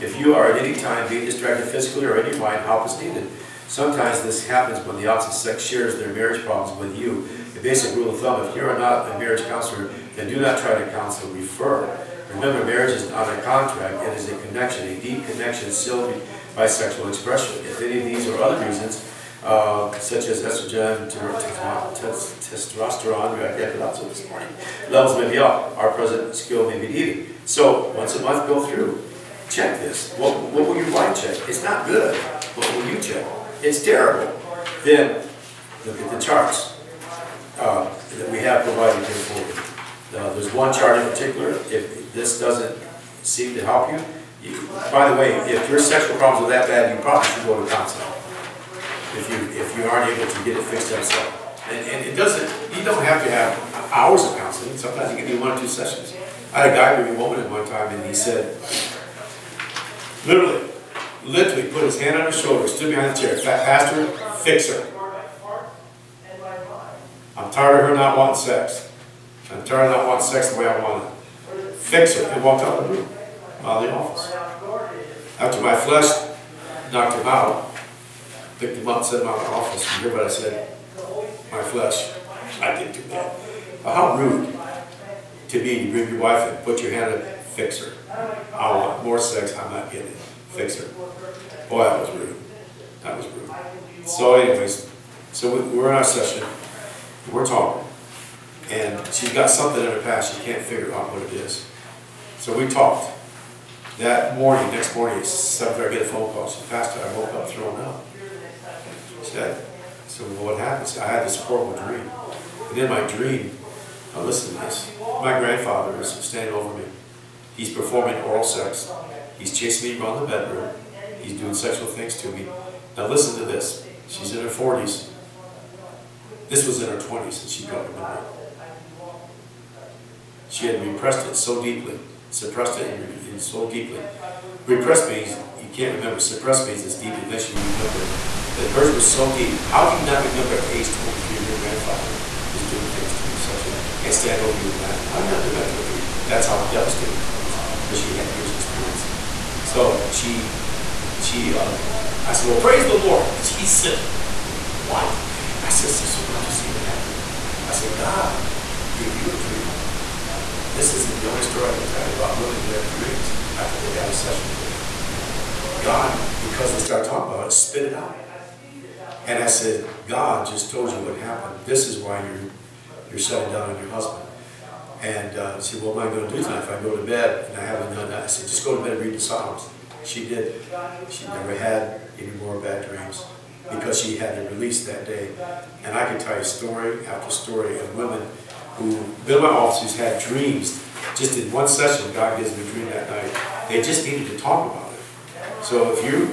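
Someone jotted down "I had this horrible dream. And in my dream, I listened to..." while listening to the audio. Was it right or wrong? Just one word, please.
right.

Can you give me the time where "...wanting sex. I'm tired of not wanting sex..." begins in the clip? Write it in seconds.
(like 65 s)
68 s.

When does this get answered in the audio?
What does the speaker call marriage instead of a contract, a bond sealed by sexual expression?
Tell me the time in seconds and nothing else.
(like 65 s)
14 s.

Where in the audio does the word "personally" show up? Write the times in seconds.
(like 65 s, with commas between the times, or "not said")
not said.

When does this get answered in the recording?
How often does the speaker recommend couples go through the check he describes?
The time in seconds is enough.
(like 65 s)
27 s.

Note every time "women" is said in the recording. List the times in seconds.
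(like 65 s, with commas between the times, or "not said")
162 s, 187 s.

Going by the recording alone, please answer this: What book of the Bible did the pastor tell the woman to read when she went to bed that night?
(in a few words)
Psalms.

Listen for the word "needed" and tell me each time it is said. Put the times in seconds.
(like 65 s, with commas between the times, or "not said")
3 s, 26 s, 194 s.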